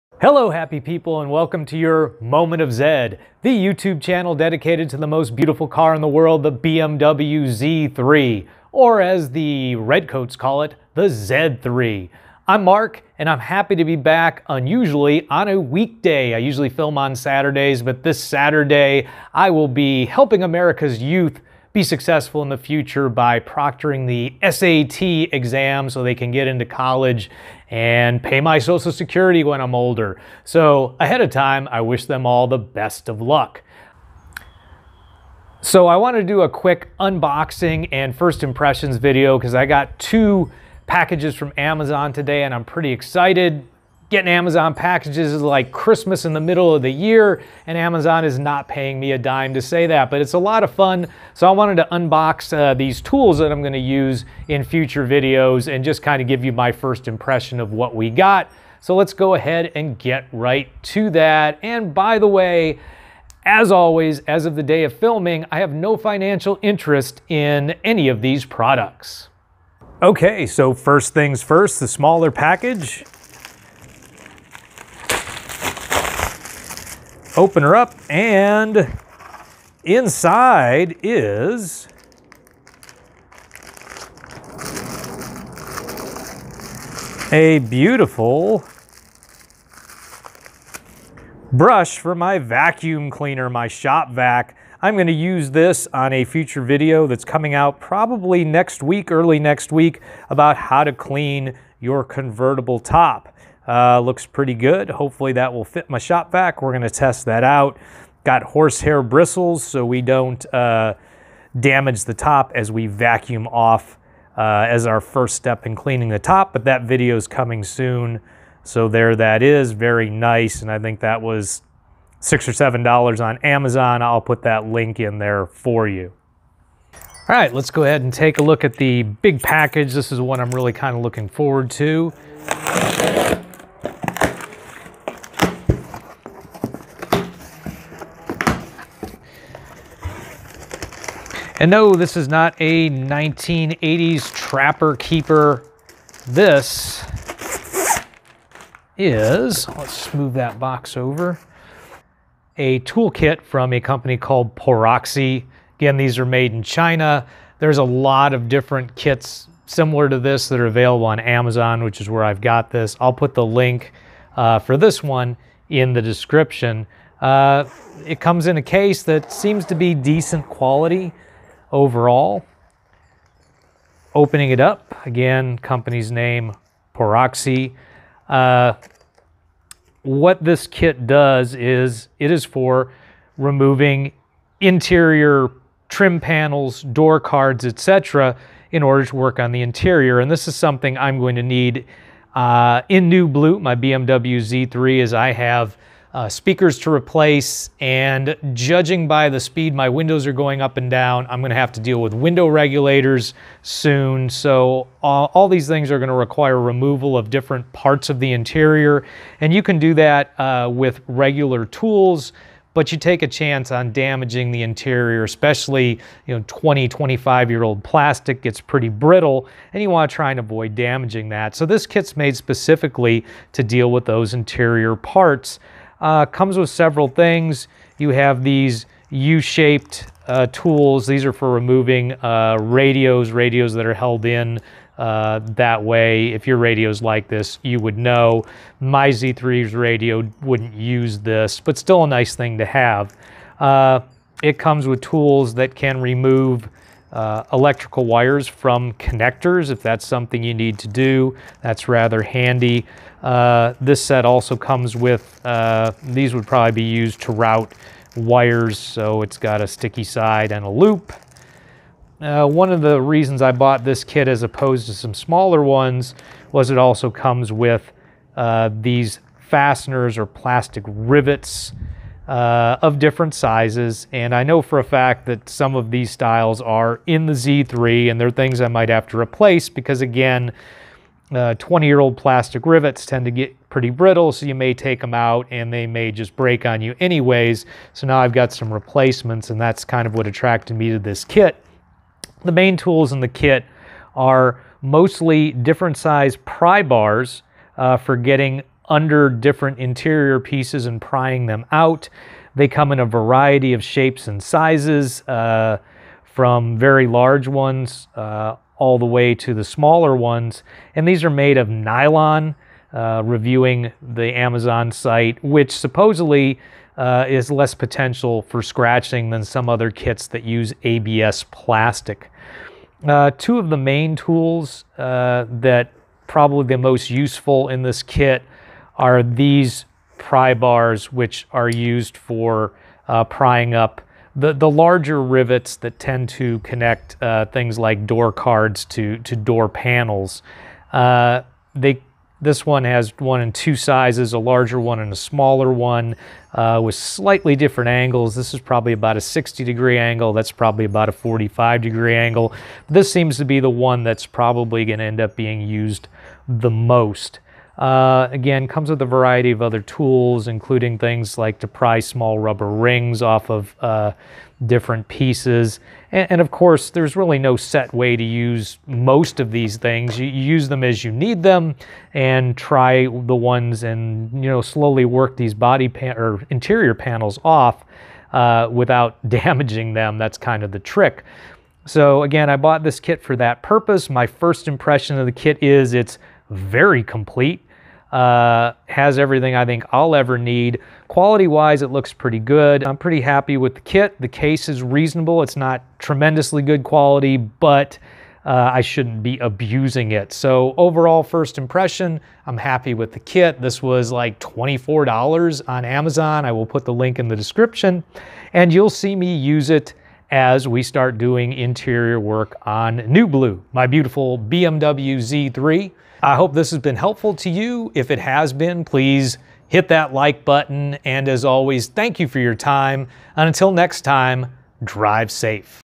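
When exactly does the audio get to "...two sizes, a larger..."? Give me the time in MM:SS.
05:43.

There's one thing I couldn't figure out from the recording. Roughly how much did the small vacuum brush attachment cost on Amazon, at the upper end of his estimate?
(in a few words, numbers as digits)
$7.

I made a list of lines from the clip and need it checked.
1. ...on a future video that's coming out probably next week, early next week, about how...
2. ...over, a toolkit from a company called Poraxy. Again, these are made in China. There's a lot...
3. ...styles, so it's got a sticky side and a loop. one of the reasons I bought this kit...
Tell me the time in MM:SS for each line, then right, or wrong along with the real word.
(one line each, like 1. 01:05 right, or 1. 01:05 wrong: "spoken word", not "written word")
1. 01:35 right
2. 02:30 right
3. 04:18 wrong: "wires", not "styles".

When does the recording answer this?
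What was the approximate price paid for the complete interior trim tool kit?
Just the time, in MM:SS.
06:44.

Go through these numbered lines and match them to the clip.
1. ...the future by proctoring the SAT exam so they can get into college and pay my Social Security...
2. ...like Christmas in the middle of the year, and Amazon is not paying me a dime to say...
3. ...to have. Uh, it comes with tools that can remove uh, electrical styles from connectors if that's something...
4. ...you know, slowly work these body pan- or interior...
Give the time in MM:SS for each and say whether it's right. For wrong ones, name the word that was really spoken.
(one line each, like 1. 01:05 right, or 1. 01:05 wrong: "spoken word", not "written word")
1. 00:22 right
2. 00:45 right
3. 04:02 wrong: "wires", not "styles"
4. 06:14 right.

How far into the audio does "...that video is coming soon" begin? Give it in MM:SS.
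01:56.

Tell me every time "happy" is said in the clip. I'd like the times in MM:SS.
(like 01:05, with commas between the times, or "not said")
00:00, 00:13, 06:33, 06:42.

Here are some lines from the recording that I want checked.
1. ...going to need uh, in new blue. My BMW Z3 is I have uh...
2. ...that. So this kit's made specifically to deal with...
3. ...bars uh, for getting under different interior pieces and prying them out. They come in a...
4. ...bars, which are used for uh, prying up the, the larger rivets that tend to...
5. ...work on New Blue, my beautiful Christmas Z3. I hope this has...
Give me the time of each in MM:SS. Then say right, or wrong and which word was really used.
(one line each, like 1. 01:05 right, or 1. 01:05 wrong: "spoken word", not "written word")
1. 03:11 right
2. 03:41 right
3. 04:56 right
4. 05:30 right
5. 06:52 wrong: "BMW", not "Christmas".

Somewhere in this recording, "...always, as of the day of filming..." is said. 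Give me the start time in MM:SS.
01:03.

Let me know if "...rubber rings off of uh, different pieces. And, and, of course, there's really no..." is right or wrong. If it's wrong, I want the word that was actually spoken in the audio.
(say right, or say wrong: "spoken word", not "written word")
right.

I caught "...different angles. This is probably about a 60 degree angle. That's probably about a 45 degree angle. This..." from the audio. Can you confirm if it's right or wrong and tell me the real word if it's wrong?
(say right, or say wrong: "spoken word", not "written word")
right.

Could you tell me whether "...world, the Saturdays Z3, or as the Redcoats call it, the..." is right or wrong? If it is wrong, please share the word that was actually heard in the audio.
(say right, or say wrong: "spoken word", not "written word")
wrong: "BMW", not "Saturdays".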